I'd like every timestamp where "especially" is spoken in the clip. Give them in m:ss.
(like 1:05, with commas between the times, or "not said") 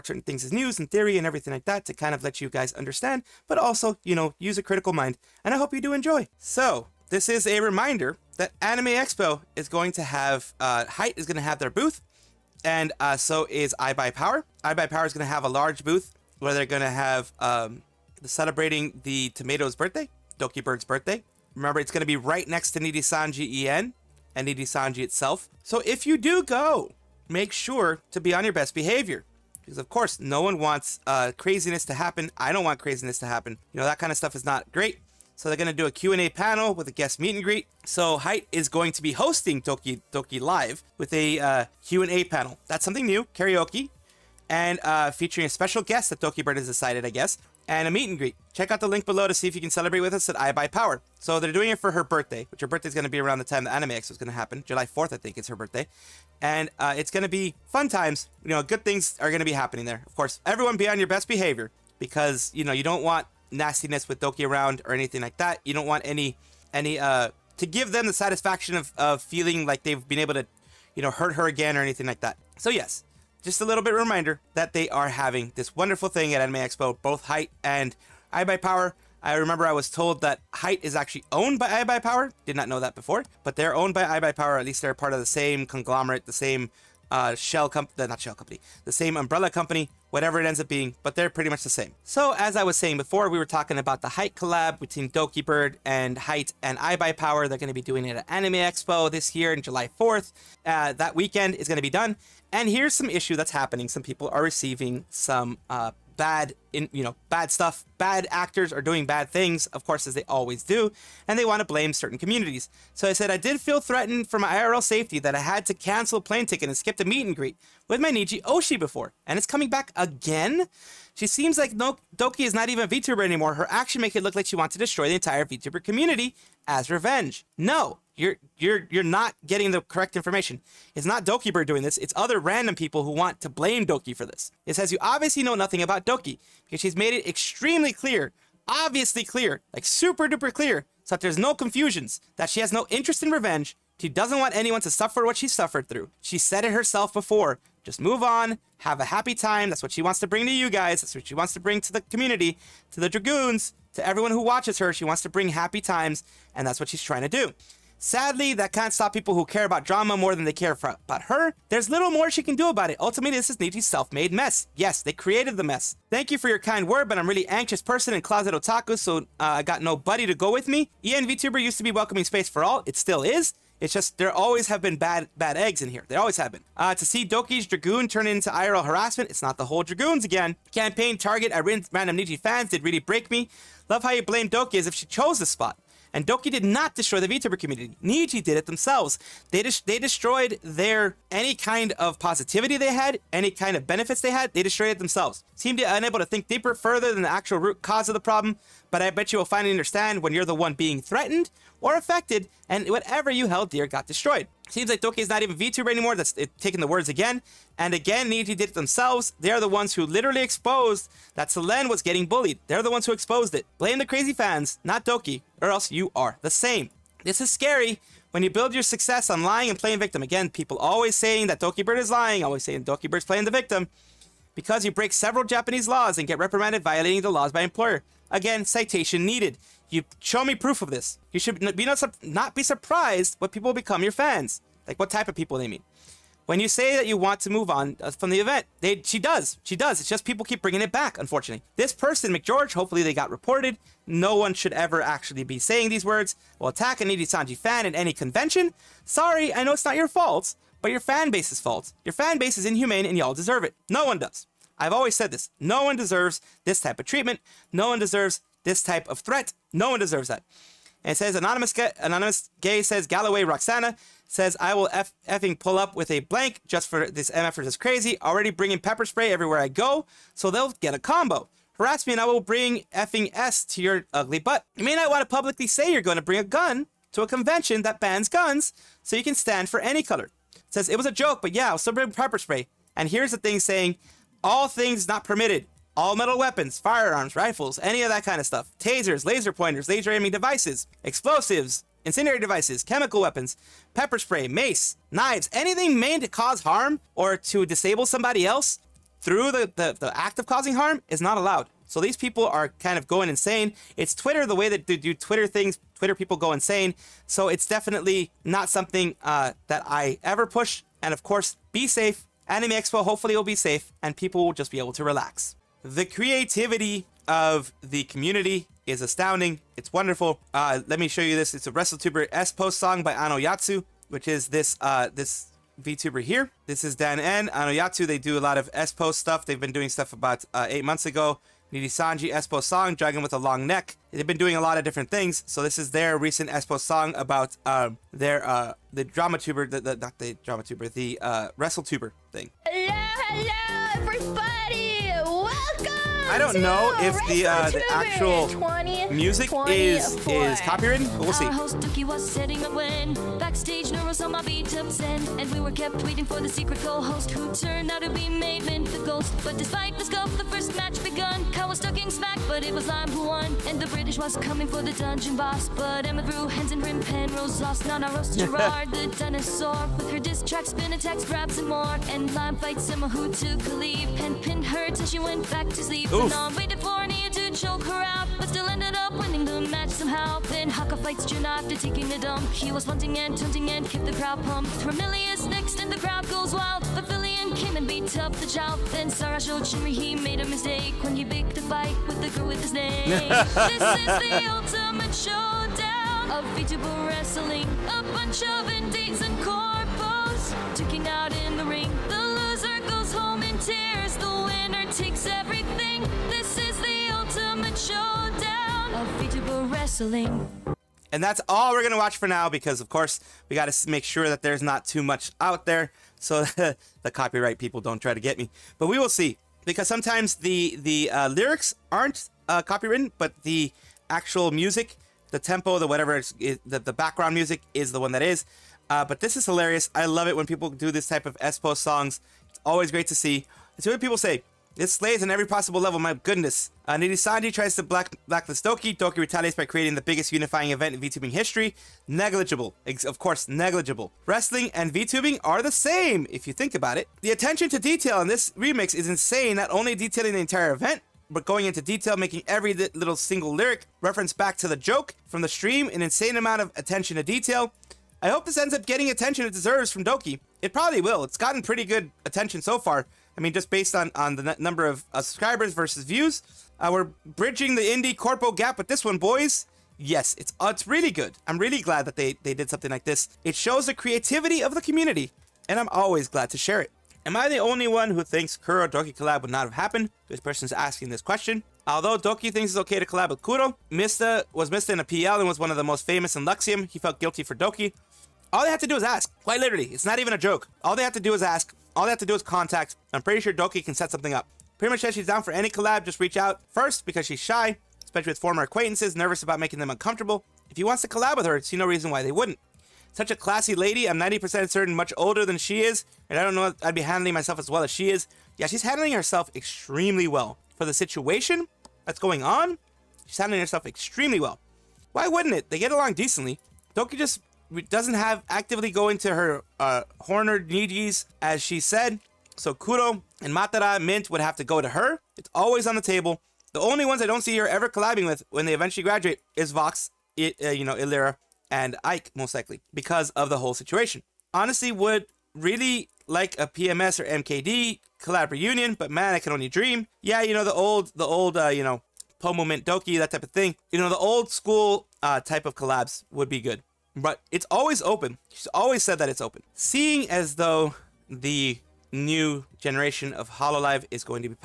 8:18.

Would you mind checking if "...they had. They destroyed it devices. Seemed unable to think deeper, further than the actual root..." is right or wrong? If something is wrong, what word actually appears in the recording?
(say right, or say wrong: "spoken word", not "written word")
wrong: "themselves", not "devices".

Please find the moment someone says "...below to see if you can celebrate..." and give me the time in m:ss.
0:49.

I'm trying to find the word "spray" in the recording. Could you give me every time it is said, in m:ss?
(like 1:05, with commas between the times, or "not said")
4:29, 4:42, 4:54.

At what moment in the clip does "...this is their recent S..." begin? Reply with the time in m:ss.
5:35.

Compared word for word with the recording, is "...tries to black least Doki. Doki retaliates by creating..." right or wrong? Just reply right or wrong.
wrong.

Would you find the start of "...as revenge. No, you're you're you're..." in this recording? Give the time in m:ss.
2:06.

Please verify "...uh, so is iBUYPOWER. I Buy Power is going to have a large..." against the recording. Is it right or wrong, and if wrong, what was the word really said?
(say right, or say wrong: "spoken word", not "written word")
right.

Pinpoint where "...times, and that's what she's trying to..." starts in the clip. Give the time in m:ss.
2:35.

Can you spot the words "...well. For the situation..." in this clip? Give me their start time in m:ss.
8:30.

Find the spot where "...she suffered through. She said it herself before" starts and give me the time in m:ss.
2:25.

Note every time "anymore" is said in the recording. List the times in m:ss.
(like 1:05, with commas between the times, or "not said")
2:03, 3:25.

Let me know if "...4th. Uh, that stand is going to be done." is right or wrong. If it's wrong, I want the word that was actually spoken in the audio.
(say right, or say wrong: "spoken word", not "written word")
wrong: "weekend", not "stand".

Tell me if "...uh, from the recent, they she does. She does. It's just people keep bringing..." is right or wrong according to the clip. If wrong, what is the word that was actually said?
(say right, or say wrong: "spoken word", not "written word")
wrong: "event", not "recent".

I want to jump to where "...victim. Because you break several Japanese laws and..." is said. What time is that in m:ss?
3:43.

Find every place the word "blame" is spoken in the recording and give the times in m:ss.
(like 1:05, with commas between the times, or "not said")
1:51, 2:13, 3:04, 3:33.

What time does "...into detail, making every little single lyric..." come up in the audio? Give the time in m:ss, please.
7:31.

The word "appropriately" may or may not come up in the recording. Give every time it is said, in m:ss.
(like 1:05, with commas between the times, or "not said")
not said.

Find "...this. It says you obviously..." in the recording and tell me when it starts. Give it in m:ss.
2:14.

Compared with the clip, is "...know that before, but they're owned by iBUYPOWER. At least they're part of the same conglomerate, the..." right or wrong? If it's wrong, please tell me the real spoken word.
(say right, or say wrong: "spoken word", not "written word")
right.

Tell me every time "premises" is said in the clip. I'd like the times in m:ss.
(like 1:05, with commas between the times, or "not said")
not said.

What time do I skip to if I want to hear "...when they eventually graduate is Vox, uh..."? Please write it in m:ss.
8:48.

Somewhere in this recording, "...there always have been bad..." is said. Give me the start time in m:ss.
2:54.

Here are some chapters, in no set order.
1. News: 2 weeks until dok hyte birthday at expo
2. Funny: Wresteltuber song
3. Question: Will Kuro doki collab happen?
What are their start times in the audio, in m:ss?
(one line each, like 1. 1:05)
1. 0:06
2. 5:15
3. 5:57.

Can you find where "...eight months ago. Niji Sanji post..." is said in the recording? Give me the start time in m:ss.
5:30.